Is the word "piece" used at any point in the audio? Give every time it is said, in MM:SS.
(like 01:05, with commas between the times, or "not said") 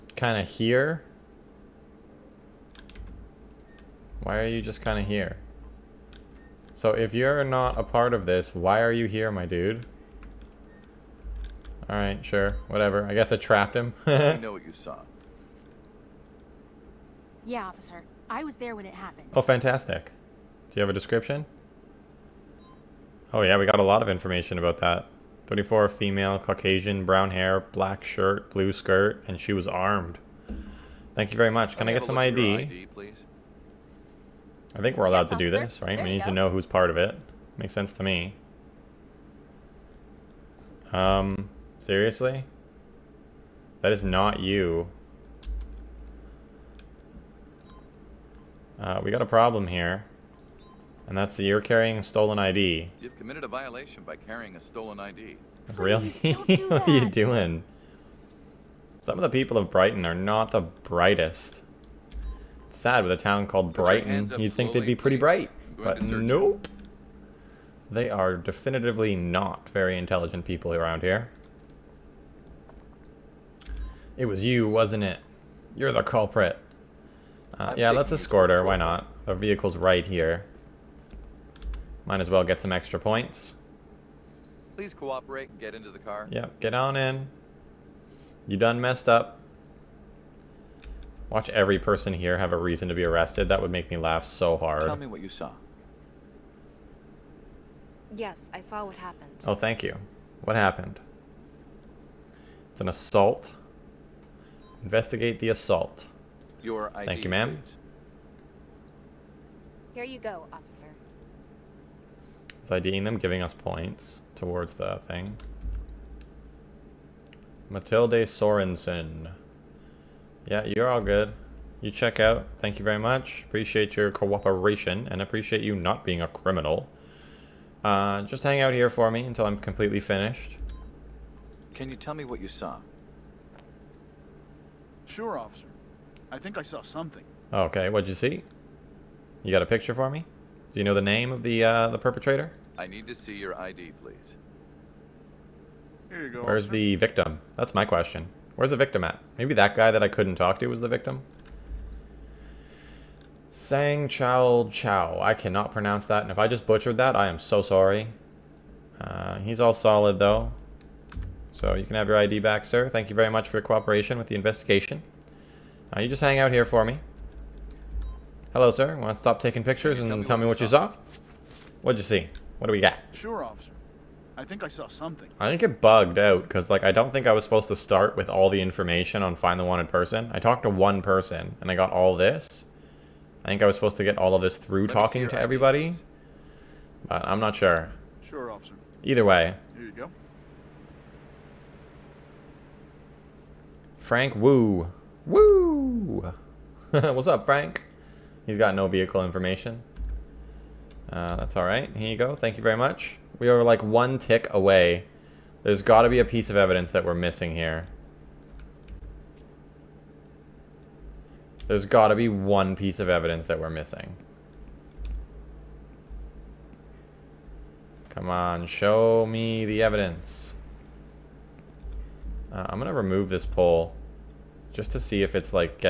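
03:26, 03:32.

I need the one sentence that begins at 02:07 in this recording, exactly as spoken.
Uh, just hang out here for me until I'm completely finished.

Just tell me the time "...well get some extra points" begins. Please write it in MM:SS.
01:22.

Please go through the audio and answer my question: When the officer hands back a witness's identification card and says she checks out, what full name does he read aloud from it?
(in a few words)
Matilde Sorensen.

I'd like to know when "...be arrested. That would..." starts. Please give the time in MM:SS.
01:32.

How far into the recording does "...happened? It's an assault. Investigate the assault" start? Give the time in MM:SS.
01:40.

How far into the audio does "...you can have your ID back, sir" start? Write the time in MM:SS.
02:41.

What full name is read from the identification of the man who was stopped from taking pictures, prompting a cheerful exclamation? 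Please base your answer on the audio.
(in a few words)
Frank Woo.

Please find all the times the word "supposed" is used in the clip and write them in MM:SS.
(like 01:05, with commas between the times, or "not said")
02:57, 03:03.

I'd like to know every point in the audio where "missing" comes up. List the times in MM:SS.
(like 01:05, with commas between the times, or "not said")
03:27, 03:33.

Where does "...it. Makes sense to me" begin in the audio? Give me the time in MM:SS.
00:36.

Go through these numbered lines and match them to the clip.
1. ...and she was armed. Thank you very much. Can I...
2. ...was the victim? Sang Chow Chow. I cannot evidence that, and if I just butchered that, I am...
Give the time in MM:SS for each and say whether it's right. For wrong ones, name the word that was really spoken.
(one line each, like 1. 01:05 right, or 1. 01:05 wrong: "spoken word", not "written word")
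1. 00:29 right
2. 02:30 wrong: "pronounce", not "evidence".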